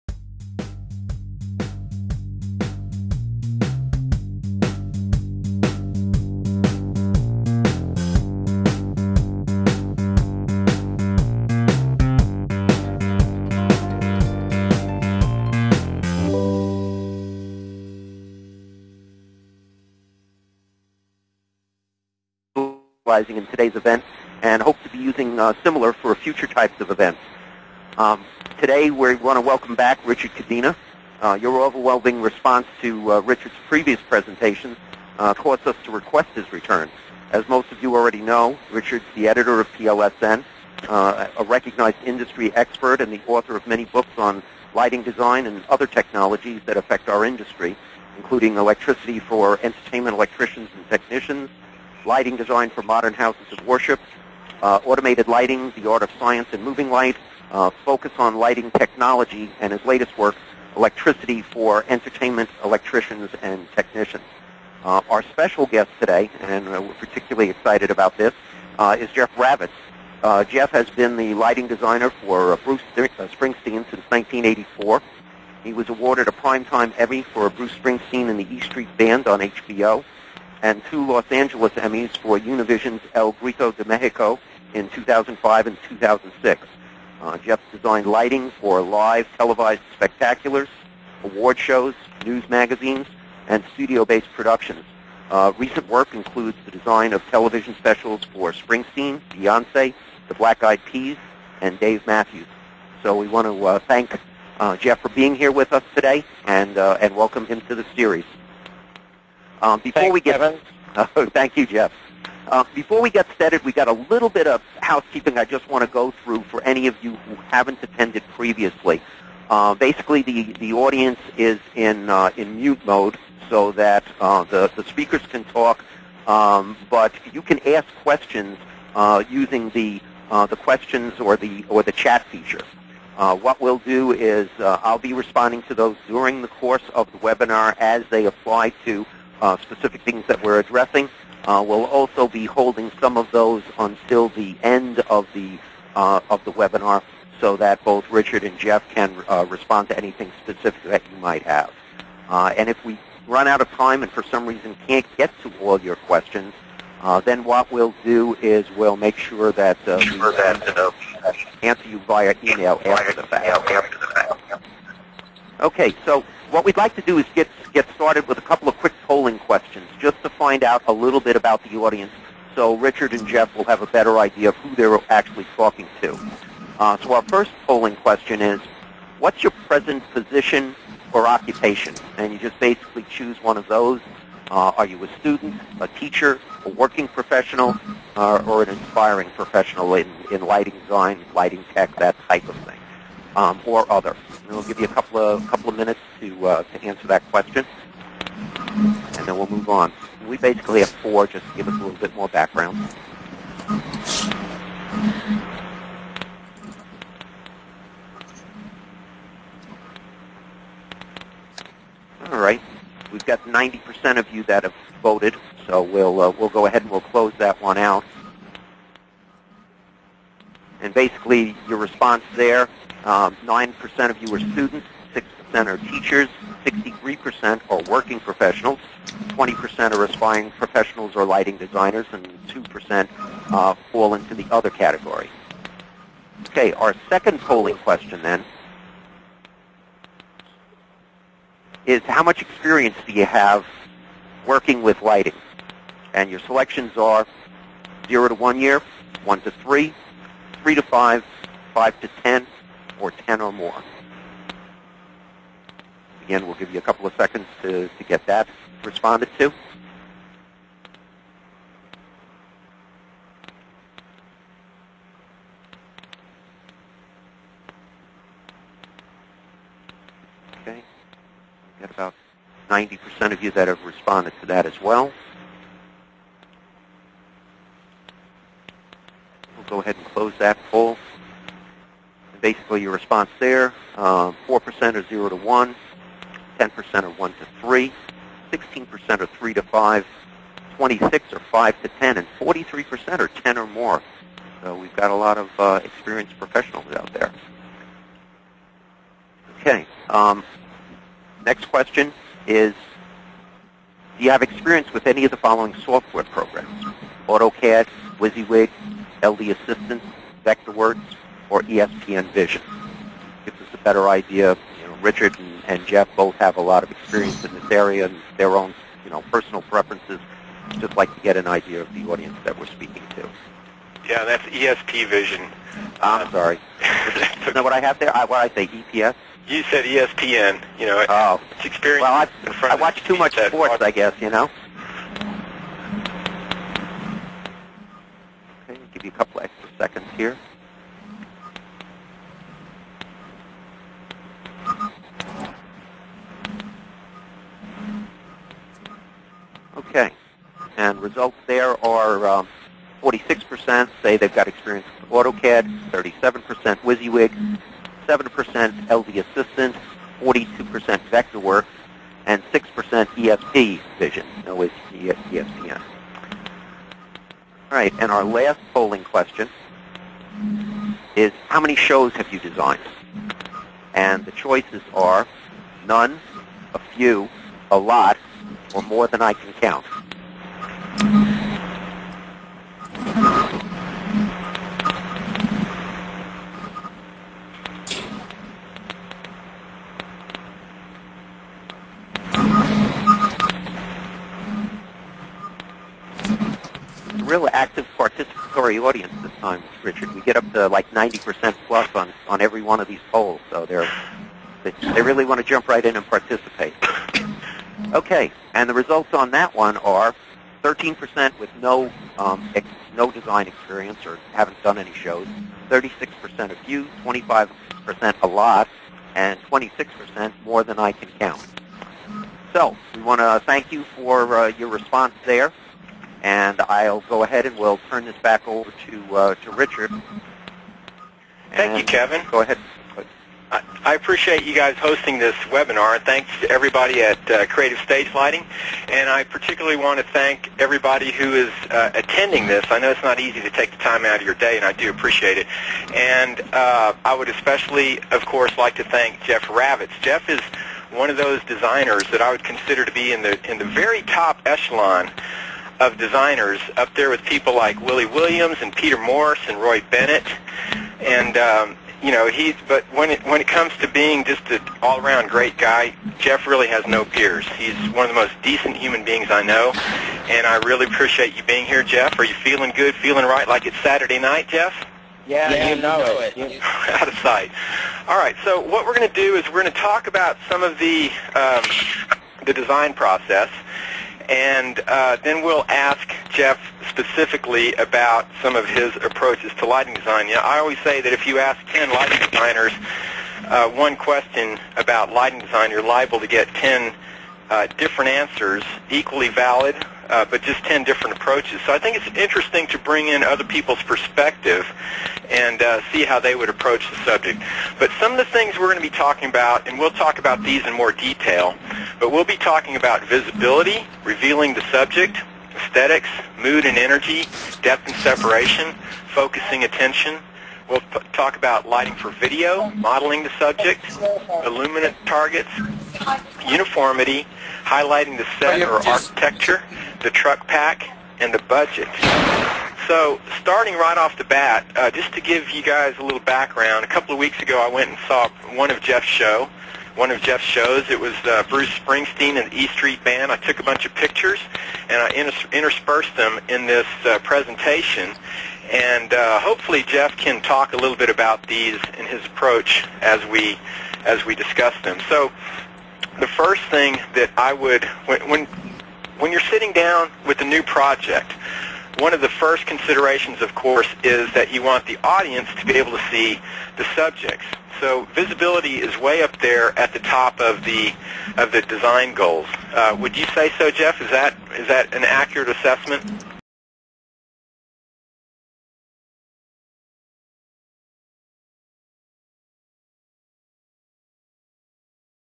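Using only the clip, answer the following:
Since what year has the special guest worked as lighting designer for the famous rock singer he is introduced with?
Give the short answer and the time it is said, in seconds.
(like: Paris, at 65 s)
1984, at 74 s.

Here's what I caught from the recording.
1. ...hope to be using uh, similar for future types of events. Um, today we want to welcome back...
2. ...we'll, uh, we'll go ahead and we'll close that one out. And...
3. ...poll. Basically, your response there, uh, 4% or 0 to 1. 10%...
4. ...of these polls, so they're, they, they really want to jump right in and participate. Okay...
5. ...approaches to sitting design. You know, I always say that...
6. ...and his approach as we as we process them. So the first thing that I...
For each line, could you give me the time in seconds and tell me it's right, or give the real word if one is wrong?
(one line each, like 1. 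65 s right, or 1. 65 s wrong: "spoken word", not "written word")
1. 24 s right
2. 215 s right
3. 280 s right
4. 402 s right
5. 488 s wrong: "lighting", not "sitting"
6. 551 s wrong: "discuss", not "process".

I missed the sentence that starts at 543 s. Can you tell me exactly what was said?
I took a bunch of pictures and I inter- interspersed them in this uh, presentation.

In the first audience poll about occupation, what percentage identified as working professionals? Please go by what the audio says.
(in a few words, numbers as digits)
63%.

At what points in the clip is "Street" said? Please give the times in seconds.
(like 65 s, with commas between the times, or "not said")
78 s, 542 s.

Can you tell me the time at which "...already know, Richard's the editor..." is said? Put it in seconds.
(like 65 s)
37 s.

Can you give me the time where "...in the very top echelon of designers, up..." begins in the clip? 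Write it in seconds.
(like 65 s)
453 s.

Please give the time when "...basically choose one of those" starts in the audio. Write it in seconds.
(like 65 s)
182 s.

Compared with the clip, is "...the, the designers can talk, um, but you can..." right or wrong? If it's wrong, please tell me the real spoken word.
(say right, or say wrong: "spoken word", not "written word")
wrong: "speakers", not "designers".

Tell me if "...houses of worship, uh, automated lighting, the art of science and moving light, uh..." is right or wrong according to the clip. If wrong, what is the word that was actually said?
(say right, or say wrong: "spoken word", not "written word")
right.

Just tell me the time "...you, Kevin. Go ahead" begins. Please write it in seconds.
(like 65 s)
431 s.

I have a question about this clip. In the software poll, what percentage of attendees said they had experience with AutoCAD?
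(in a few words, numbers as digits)
46%.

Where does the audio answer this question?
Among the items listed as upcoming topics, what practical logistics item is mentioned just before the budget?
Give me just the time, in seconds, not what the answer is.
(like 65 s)
530 s.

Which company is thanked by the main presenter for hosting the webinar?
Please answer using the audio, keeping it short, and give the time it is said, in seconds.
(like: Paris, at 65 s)
Creative Stage Lighting, at 437 s.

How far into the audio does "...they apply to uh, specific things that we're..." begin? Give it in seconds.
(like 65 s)
138 s.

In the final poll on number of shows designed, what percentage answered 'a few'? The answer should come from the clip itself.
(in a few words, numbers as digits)
36%.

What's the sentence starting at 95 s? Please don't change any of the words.
Uh, recent work includes the design of television specials for Springsteen, Beyonce, the Black Eyed Peas, and Dave Matthews.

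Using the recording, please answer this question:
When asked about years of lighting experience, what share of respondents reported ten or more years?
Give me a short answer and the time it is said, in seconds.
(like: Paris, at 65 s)
43%, at 292 s.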